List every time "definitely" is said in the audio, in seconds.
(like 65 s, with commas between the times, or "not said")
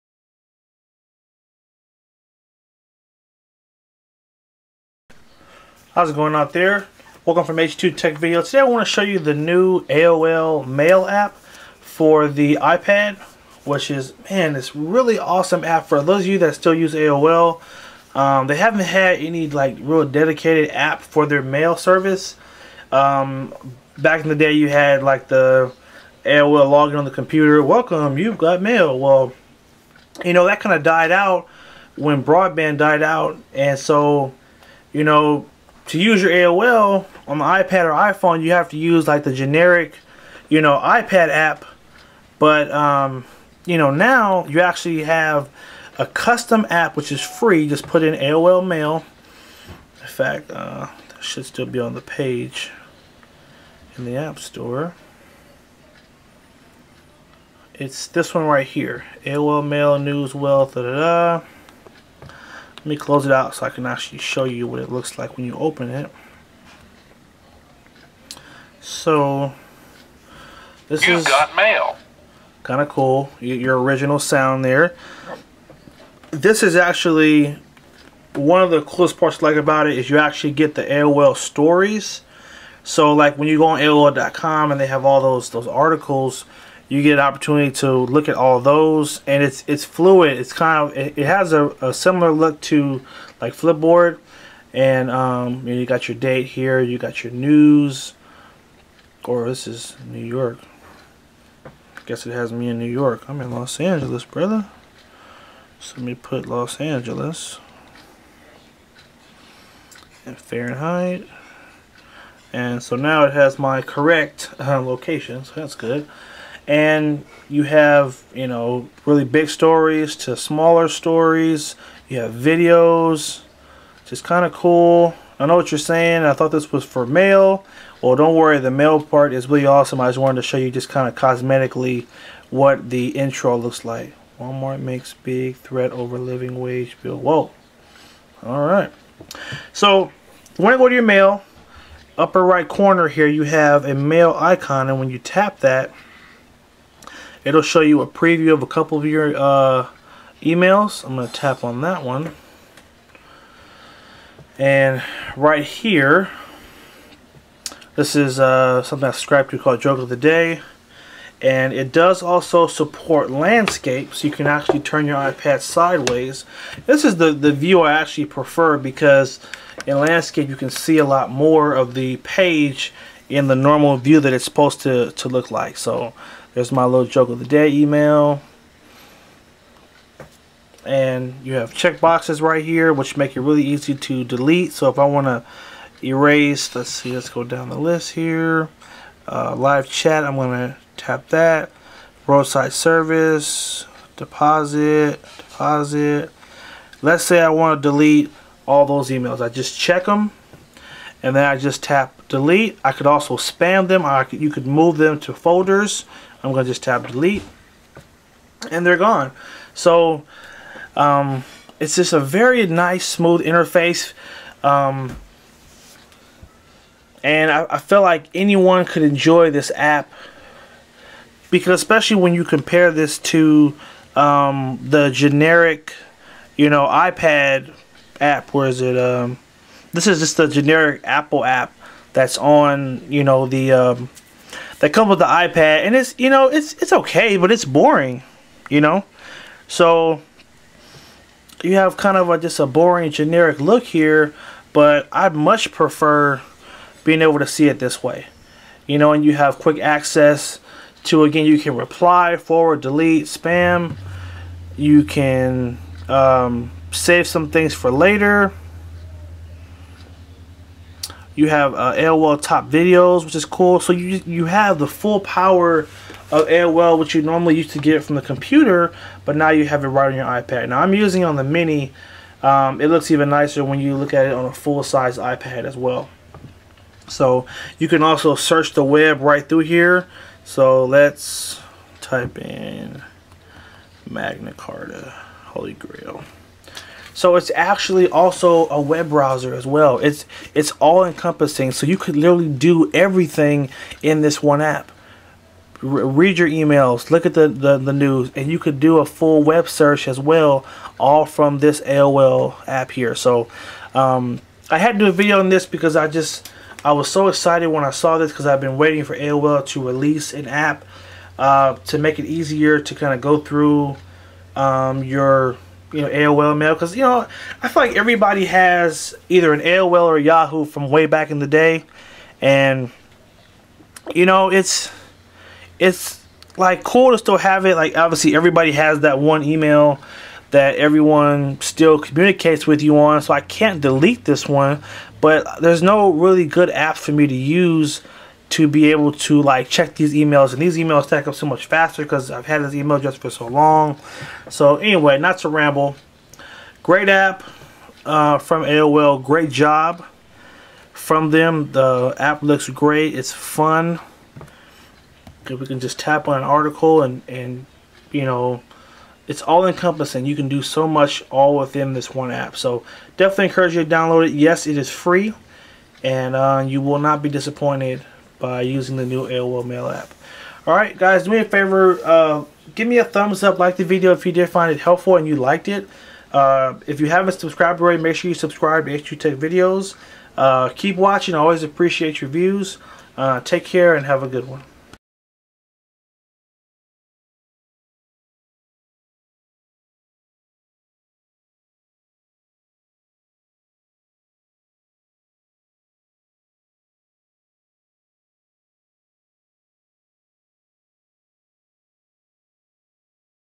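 363 s.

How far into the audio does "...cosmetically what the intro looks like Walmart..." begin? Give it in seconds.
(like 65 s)
131 s.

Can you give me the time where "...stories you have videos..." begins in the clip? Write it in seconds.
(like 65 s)
120 s.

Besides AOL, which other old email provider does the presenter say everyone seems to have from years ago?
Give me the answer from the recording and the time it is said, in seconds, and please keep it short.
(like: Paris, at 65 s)
Yahoo, at 320 s.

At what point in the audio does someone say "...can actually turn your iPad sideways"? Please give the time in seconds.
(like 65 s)
164 s.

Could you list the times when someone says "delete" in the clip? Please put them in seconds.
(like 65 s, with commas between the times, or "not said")
184 s, 197 s, 202 s, 207 s, 252 s, 333 s.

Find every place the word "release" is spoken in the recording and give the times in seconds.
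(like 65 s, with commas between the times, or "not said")
309 s.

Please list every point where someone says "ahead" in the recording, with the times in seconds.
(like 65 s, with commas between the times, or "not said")
not said.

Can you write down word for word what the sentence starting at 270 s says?
Now I'm using it on the Mini.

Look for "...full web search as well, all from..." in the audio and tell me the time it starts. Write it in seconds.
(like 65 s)
299 s.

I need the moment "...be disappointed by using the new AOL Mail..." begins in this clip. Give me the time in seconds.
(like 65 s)
367 s.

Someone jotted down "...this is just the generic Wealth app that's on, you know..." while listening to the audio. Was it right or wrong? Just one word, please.
wrong.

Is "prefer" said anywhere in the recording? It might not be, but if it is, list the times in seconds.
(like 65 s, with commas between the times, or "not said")
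168 s, 245 s.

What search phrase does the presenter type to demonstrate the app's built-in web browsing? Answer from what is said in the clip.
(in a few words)
Magna Carta, Holy Grail.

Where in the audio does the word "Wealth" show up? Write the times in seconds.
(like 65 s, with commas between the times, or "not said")
60 s.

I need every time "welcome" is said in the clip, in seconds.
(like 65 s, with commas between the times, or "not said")
7 s, 27 s.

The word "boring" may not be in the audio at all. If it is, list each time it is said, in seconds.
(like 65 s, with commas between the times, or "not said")
237 s, 242 s.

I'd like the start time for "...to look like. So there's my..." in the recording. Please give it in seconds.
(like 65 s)
175 s.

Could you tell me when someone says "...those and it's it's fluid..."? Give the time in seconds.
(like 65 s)
88 s.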